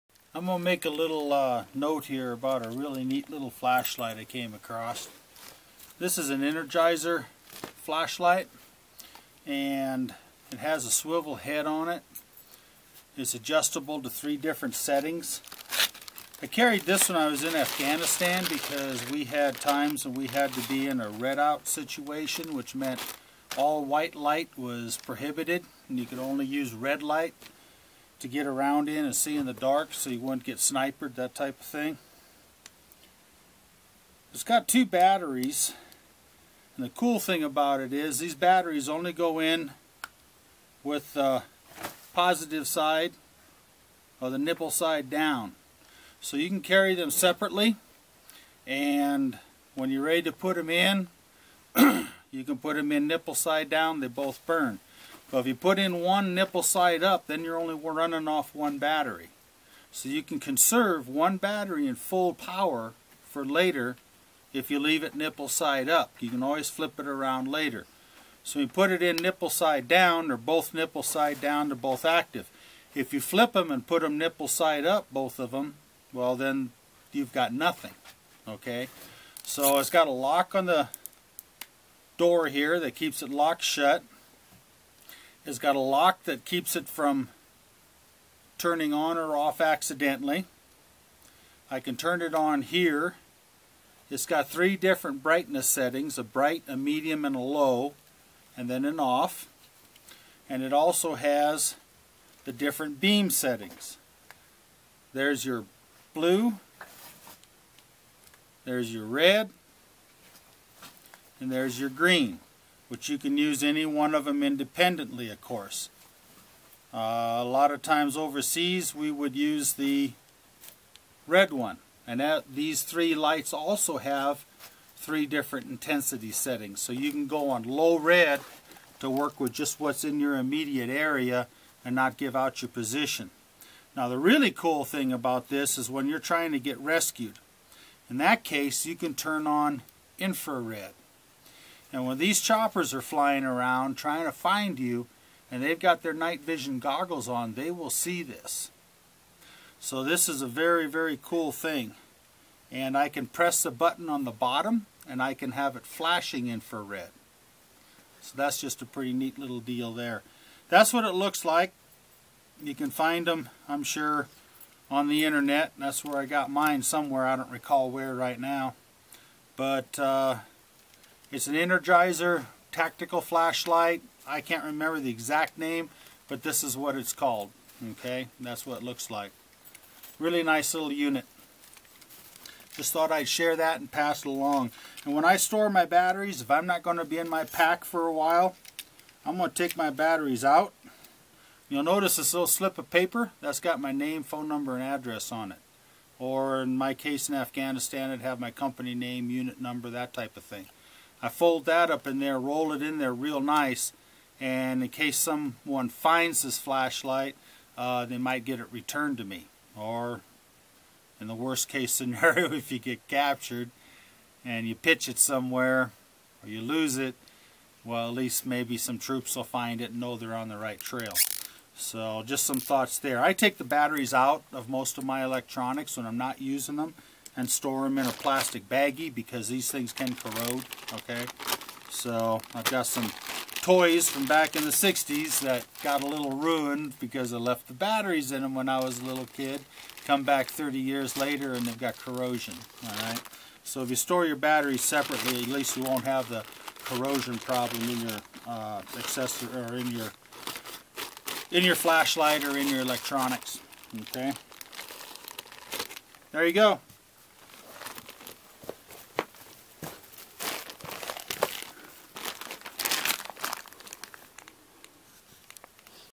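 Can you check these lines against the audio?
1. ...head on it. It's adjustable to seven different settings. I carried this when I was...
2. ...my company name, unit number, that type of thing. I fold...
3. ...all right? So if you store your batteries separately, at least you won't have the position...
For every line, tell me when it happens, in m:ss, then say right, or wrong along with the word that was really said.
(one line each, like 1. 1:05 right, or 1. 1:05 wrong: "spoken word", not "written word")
1. 0:11 wrong: "three", not "seven"
2. 3:18 right
3. 4:02 wrong: "corrosion", not "position".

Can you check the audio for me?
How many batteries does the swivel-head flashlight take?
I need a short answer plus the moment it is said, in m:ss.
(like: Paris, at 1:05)
2, at 0:34.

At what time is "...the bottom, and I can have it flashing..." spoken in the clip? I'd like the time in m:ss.
2:34.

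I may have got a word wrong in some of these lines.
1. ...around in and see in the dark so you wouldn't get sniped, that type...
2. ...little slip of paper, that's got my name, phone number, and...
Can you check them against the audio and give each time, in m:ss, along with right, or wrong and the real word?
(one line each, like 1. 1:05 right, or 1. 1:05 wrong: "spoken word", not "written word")
1. 0:28 right
2. 3:12 right.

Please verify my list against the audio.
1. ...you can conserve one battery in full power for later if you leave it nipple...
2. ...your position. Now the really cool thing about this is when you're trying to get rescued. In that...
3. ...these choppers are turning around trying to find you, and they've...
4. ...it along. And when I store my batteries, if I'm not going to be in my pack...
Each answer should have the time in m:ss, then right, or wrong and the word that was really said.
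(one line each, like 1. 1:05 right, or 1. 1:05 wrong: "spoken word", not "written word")
1. 1:00 right
2. 2:12 right
3. 2:22 wrong: "flying", not "turning"
4. 3:04 right.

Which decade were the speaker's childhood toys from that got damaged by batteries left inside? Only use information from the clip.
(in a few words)
The 60s.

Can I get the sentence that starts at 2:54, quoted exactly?
I can't remember the exact name, but this is what it's called.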